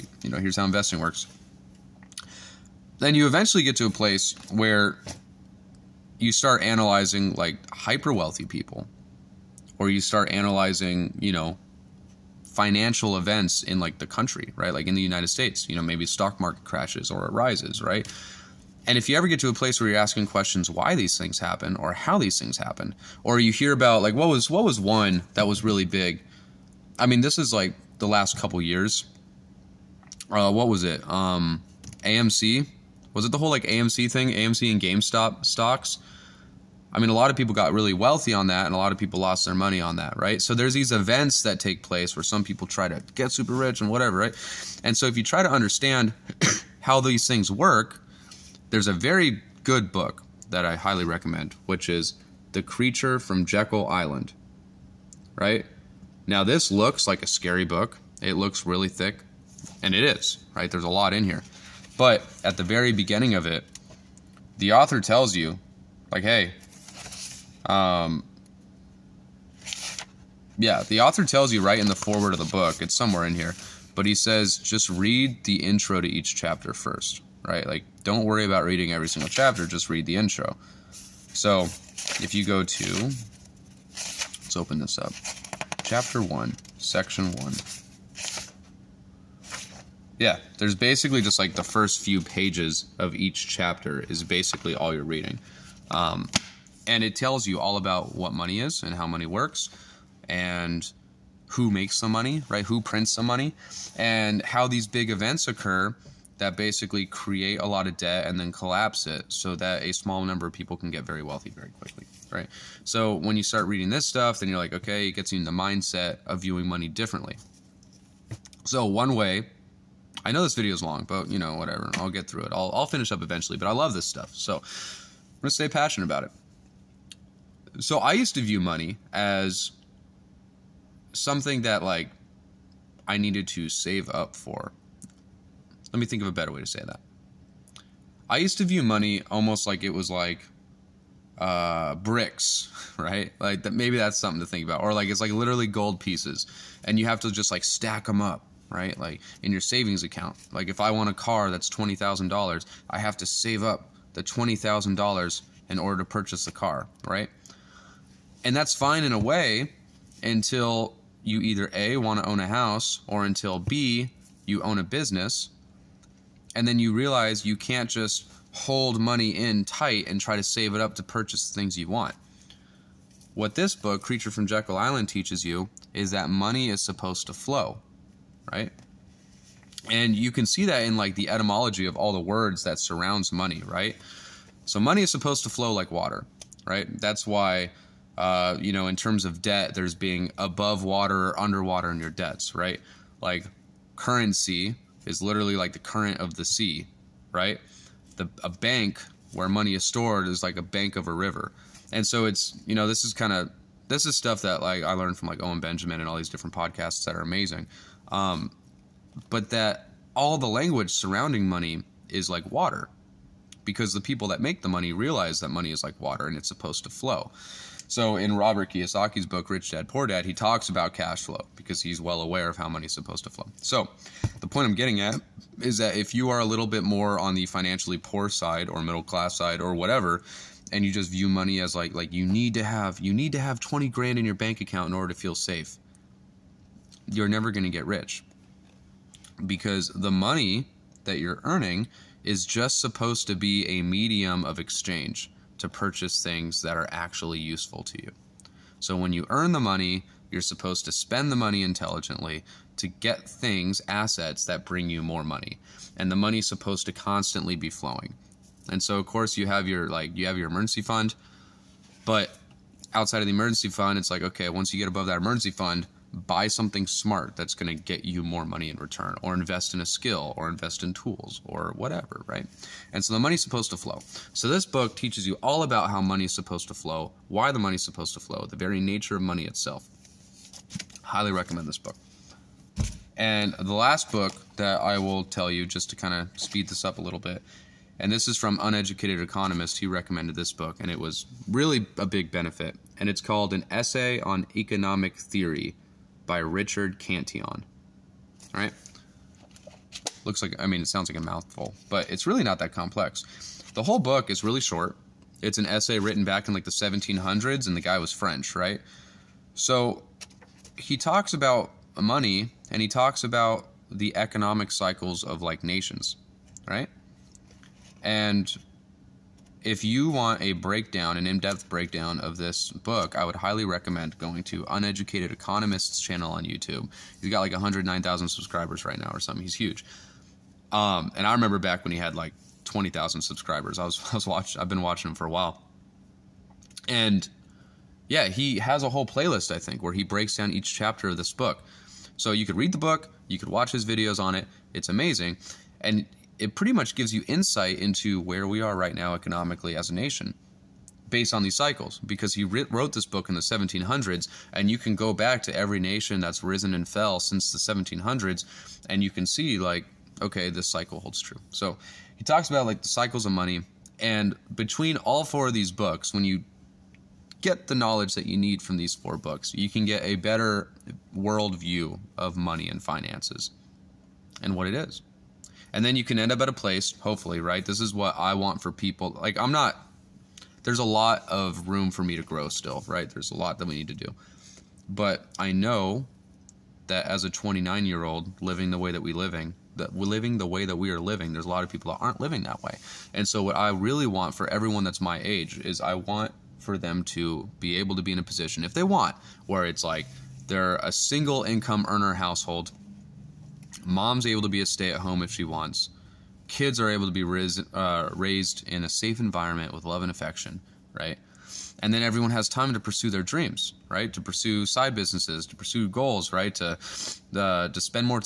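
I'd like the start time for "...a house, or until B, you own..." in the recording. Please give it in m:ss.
2:42.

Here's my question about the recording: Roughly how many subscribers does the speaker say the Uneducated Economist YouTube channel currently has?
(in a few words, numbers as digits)
109,000.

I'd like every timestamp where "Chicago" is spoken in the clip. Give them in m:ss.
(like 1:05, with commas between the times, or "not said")
not said.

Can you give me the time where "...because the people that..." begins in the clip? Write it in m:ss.
3:33.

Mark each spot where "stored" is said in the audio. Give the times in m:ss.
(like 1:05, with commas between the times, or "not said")
3:19.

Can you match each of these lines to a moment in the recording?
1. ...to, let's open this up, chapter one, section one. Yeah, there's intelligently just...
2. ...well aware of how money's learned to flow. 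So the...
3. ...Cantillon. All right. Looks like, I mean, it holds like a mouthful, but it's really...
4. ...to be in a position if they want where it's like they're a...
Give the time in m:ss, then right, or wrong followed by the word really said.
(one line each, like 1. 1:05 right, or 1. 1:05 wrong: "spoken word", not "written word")
1. 1:22 wrong: "basically", not "intelligently"
2. 3:42 wrong: "supposed", not "learned"
3. 4:56 wrong: "sounds", not "holds"
4. 6:37 right.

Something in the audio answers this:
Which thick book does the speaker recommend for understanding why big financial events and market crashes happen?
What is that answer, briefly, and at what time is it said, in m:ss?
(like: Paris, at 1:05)
The Creature from Jekyll Island, at 0:52.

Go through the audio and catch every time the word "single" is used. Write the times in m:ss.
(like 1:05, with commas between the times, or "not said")
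1:19, 6:40.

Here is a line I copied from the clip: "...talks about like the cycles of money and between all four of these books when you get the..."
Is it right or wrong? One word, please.
right.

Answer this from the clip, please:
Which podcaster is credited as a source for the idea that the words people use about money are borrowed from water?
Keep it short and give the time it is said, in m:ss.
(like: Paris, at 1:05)
Owen Benjamin, at 3:25.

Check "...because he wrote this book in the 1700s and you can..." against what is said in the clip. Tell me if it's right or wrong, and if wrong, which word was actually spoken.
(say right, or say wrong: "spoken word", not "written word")
right.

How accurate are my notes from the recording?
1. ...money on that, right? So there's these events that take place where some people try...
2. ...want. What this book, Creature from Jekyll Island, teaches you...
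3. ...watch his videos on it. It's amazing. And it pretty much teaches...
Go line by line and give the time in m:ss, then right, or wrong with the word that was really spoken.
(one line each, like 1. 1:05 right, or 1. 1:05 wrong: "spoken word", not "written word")
1. 0:39 right
2. 2:51 right
3. 5:43 wrong: "gives", not "teaches".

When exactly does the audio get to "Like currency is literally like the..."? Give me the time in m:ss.
3:13.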